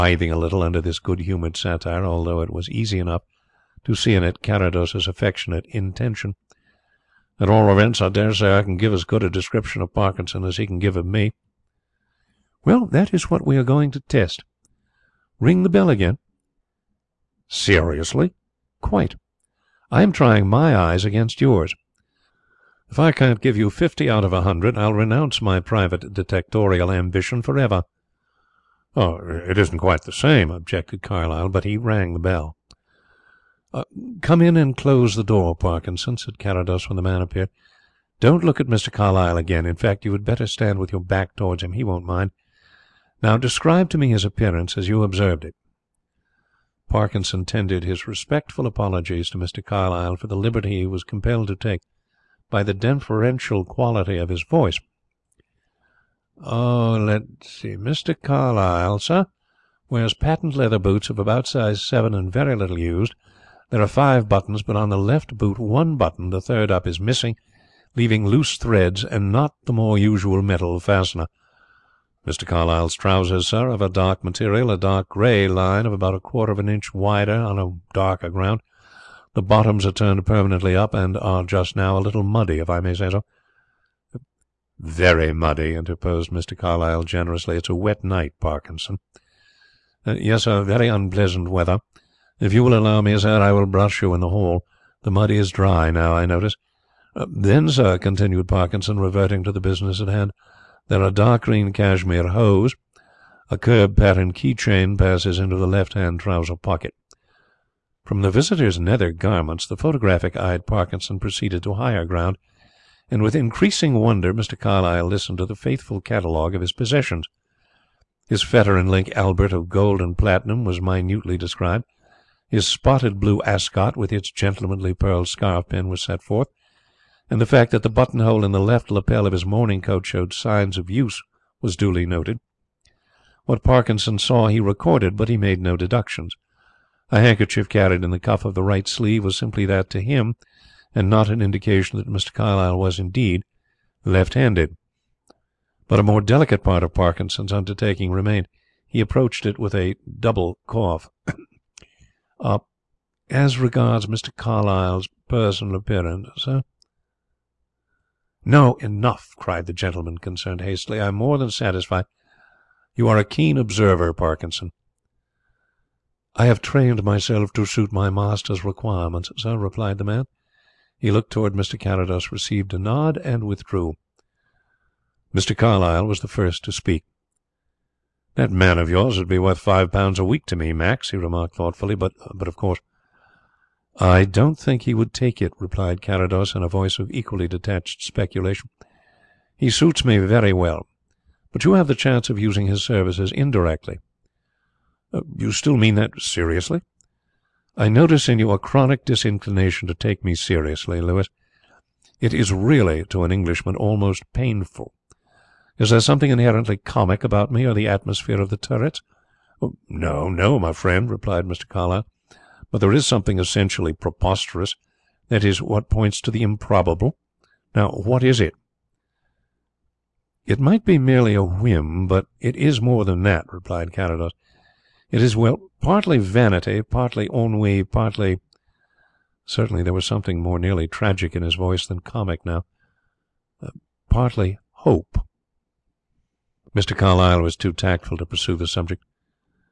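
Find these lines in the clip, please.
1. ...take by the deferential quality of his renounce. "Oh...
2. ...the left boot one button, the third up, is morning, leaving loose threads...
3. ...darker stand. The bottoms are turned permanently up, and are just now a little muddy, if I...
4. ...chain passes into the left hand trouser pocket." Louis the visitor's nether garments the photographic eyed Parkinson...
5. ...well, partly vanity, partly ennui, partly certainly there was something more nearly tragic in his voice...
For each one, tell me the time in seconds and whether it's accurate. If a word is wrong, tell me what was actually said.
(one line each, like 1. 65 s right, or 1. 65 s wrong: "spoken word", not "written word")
1. 51 s wrong: "voice", not "renounce"
2. 64 s wrong: "missing", not "morning"
3. 77 s wrong: "ground", not "stand"
4. 104 s wrong: "From", not "Louis"
5. 225 s right.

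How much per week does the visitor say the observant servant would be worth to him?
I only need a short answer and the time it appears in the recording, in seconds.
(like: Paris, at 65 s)
5 pounds, at 179 s.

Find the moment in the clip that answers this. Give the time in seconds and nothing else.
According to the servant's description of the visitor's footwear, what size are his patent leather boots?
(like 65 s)
61 s.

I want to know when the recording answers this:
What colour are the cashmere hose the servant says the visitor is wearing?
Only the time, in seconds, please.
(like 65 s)
101 s.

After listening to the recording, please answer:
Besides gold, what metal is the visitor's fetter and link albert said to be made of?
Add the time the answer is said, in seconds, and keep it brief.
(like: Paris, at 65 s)
Platinum, at 120 s.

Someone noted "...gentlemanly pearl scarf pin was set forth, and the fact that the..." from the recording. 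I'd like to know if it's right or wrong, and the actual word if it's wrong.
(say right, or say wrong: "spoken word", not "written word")
right.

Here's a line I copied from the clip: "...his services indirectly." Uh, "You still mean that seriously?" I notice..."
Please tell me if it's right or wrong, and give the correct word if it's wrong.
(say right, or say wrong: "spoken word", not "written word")
right.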